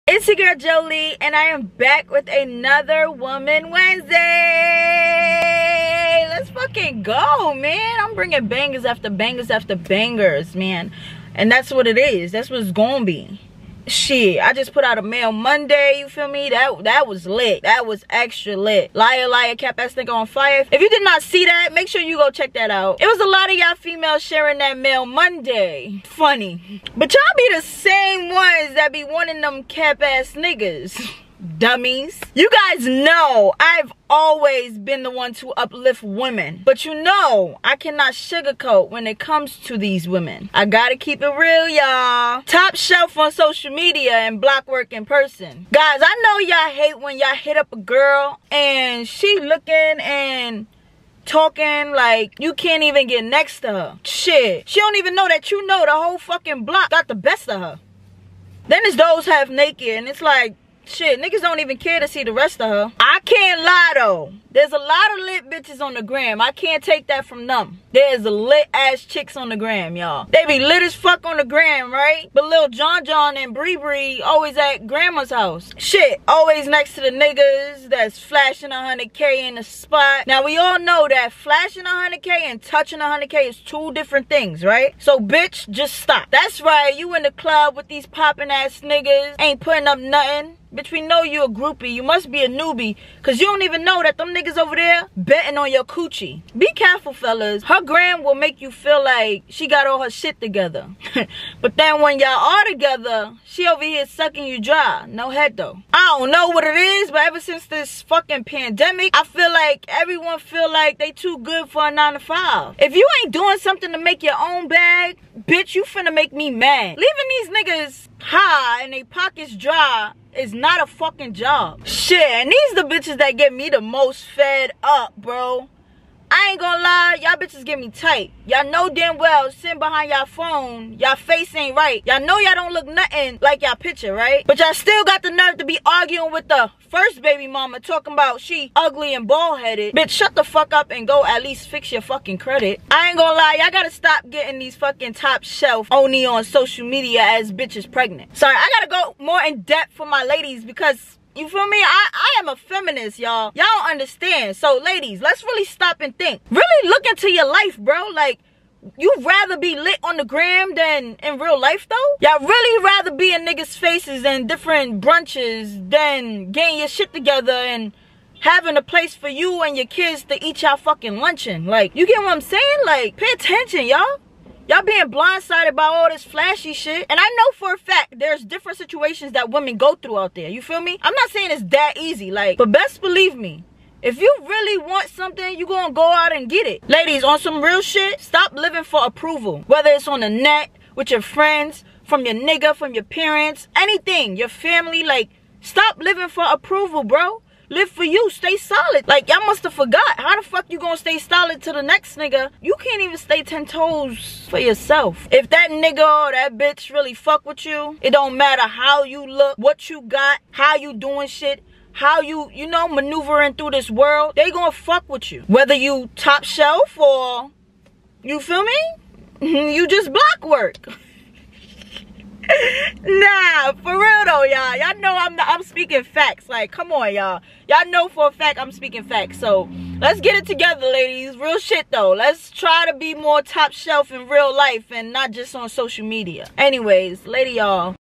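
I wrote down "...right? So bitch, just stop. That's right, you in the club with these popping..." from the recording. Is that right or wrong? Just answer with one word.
right.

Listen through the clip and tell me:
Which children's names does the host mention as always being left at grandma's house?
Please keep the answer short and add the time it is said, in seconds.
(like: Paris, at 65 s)
Lil John John and Bree Bree, at 72 s.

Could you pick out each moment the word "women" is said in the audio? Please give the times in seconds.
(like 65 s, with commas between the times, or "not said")
36 s, 40 s, 179 s.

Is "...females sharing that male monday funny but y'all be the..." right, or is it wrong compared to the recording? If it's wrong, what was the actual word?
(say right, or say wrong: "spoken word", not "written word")
right.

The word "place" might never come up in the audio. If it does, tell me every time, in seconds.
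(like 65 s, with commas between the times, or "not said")
168 s.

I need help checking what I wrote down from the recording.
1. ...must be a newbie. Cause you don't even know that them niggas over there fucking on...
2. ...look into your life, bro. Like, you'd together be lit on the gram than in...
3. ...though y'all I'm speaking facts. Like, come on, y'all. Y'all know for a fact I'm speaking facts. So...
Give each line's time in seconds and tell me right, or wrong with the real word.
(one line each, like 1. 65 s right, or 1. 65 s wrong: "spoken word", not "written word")
1. 92 s wrong: "betting", not "fucking"
2. 156 s wrong: "rather", not "together"
3. 224 s right.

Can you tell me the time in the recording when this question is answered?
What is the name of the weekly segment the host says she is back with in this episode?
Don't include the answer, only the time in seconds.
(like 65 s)
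3 s.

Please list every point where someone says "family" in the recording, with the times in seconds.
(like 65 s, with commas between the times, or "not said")
194 s.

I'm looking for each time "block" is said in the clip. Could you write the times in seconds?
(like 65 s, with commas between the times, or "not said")
44 s, 56 s, 220 s.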